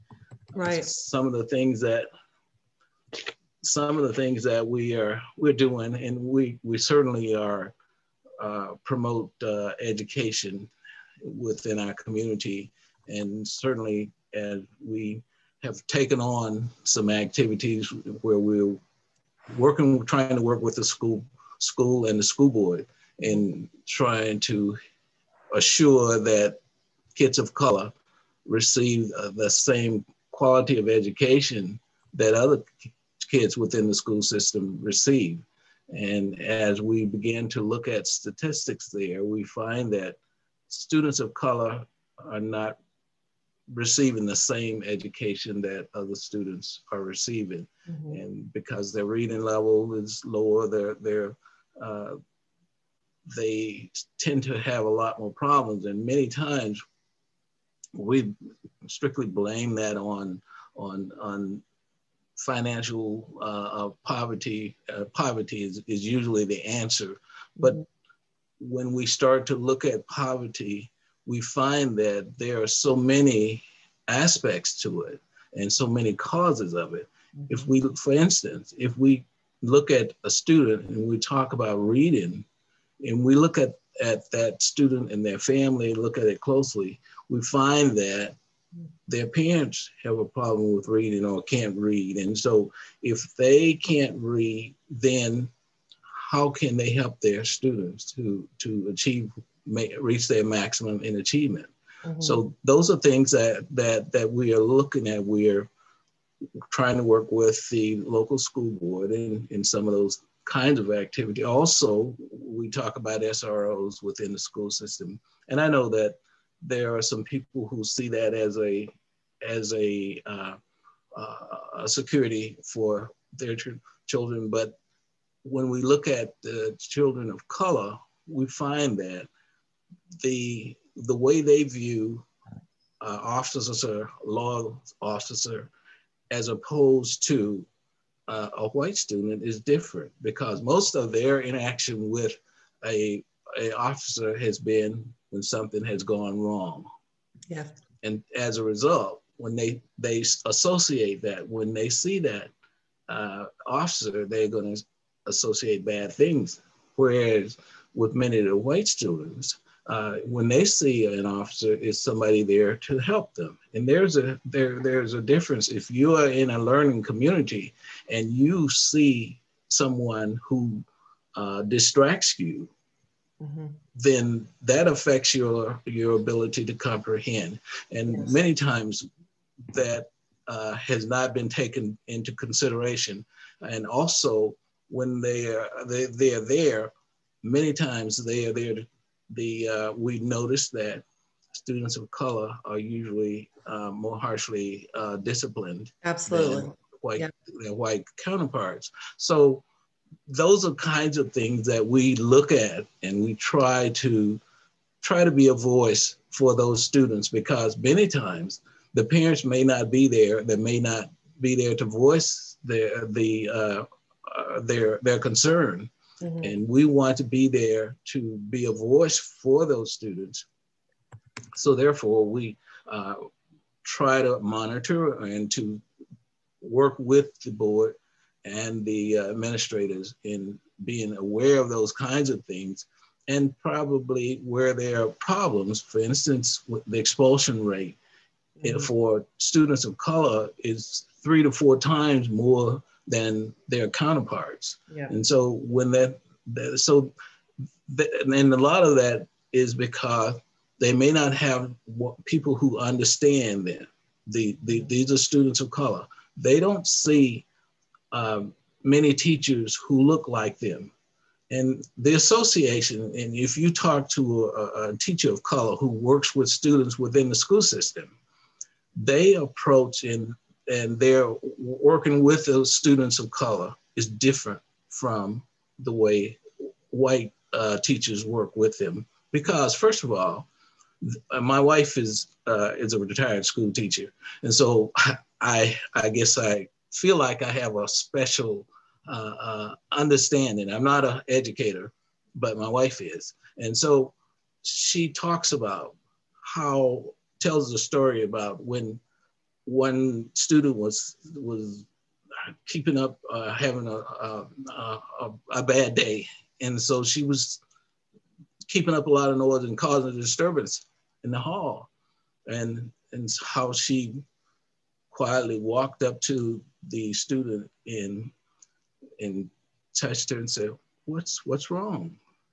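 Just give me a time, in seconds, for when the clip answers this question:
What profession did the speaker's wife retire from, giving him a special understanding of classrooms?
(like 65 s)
283 s.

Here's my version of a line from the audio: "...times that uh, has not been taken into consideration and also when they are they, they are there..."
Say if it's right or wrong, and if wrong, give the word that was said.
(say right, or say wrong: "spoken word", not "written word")
right.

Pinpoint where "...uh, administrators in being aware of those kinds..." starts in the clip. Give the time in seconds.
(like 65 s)
229 s.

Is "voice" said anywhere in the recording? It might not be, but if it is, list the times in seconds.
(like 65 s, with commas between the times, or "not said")
205 s, 211 s, 218 s.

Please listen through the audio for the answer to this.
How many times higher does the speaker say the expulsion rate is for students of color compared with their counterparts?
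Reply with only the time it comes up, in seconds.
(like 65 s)
241 s.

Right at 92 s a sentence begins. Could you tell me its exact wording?
And so if they can't read, then how can they help their students to, to achieve, reach their maximum in achievement?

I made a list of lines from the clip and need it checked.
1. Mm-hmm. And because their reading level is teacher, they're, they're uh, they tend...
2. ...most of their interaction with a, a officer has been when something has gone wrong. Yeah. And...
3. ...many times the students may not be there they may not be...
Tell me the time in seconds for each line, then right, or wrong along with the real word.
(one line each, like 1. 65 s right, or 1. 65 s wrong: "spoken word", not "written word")
1. 47 s wrong: "lower", not "teacher"
2. 140 s right
3. 207 s wrong: "parents", not "students".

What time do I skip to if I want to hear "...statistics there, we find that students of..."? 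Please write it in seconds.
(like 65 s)
38 s.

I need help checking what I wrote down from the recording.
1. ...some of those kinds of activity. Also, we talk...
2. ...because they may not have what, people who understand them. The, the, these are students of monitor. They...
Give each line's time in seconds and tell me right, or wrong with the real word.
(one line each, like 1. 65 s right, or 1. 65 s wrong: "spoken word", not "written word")
1. 109 s right
2. 249 s wrong: "color", not "monitor".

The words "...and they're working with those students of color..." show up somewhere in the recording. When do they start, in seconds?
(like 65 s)
270 s.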